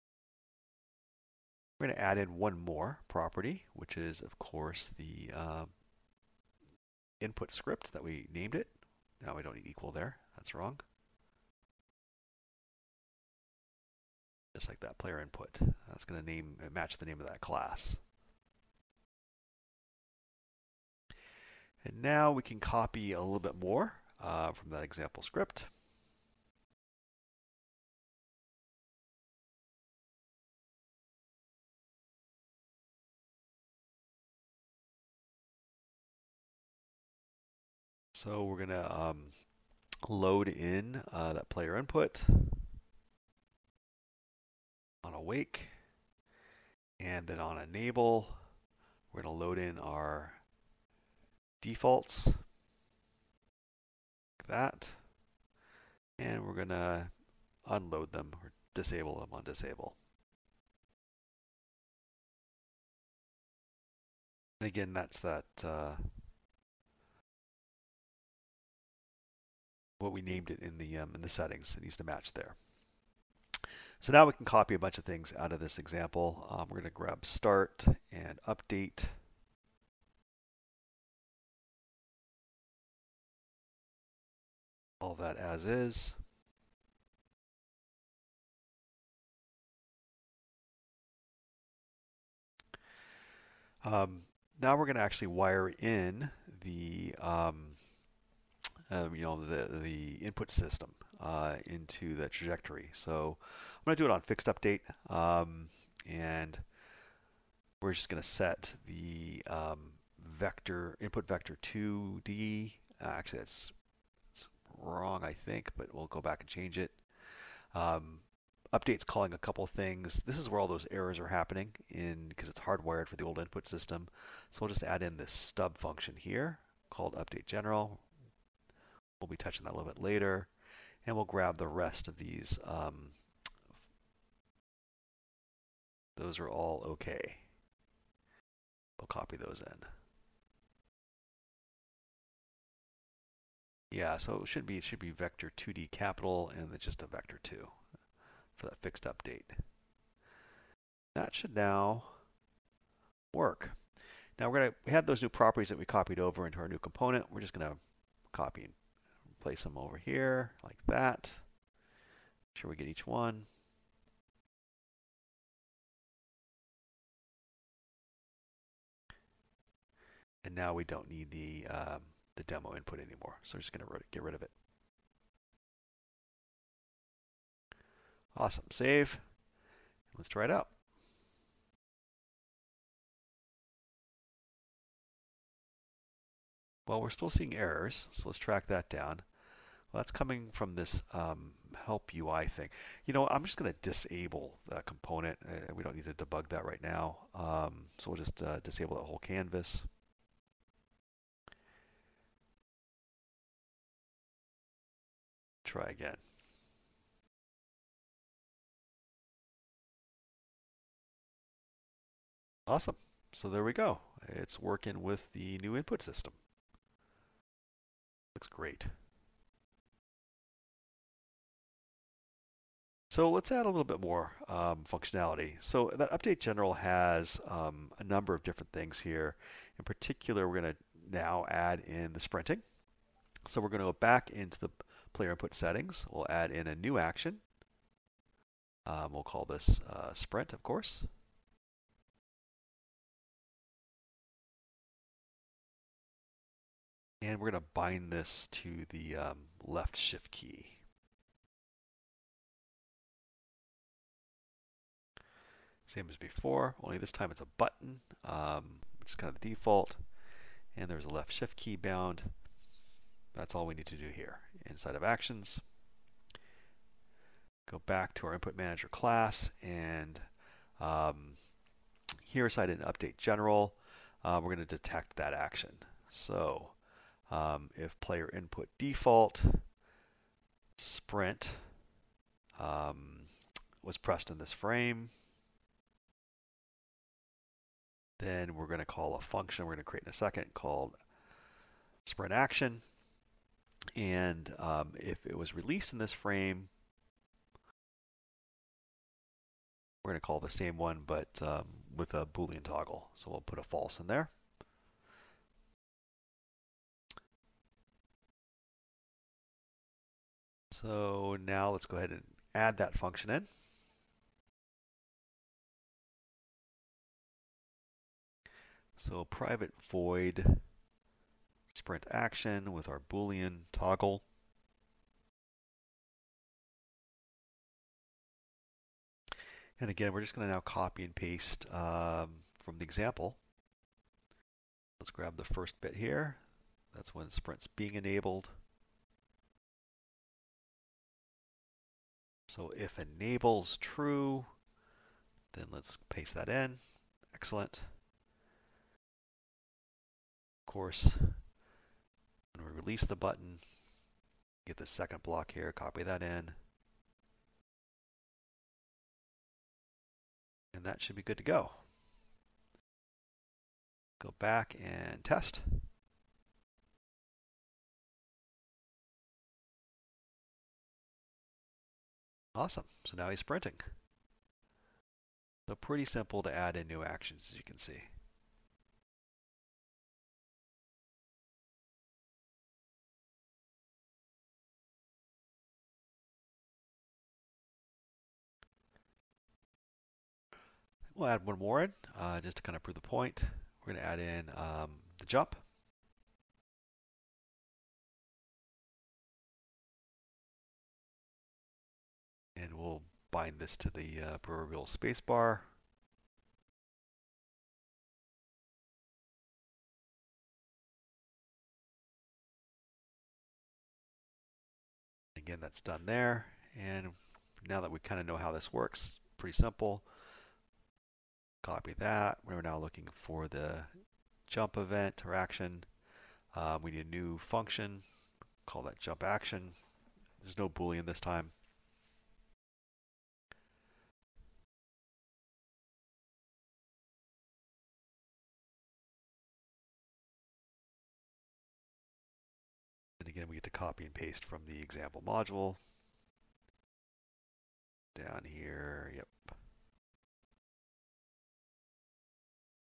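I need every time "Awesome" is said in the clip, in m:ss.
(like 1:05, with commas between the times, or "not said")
2:58, 3:32, 6:12.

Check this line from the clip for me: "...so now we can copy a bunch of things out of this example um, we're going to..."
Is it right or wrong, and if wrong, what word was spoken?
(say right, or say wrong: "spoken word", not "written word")
right.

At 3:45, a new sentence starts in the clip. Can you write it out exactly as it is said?
So that update general has um, a number of different things here.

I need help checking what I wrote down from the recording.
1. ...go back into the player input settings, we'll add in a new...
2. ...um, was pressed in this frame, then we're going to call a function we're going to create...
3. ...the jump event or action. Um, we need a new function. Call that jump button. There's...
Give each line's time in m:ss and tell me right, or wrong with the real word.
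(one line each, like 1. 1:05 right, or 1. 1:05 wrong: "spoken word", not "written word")
1. 3:53 right
2. 4:42 right
3. 7:03 wrong: "action", not "button".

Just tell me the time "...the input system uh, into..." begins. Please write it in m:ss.
1:39.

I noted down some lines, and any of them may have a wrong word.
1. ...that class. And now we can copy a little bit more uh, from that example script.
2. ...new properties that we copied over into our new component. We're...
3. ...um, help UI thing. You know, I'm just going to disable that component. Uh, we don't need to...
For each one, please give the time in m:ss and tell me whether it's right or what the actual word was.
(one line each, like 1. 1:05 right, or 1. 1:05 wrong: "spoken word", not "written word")
1. 0:17 right
2. 2:35 right
3. 3:11 right.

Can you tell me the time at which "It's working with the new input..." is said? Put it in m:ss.
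3:34.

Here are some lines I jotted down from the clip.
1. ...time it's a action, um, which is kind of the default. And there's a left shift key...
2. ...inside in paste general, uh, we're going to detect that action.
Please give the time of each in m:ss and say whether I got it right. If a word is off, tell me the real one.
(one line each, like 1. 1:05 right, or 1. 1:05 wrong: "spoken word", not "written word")
1. 4:17 wrong: "button", not "action"
2. 4:32 wrong: "update", not "paste".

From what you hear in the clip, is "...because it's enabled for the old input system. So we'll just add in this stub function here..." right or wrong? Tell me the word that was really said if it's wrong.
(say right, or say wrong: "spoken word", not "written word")
wrong: "hardwired", not "enabled".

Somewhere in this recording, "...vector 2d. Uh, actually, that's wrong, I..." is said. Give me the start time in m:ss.
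1:51.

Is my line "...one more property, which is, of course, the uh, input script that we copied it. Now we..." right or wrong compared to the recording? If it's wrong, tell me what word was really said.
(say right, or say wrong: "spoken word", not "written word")
wrong: "named", not "copied".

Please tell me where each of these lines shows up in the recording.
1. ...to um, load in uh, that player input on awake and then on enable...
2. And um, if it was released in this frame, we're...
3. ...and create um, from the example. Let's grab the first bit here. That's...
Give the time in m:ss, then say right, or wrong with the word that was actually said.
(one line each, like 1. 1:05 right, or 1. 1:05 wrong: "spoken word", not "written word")
1. 0:38 right
2. 4:53 right
3. 5:31 wrong: "paste", not "create".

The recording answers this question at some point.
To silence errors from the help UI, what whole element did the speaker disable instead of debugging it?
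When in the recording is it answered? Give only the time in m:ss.
3:19.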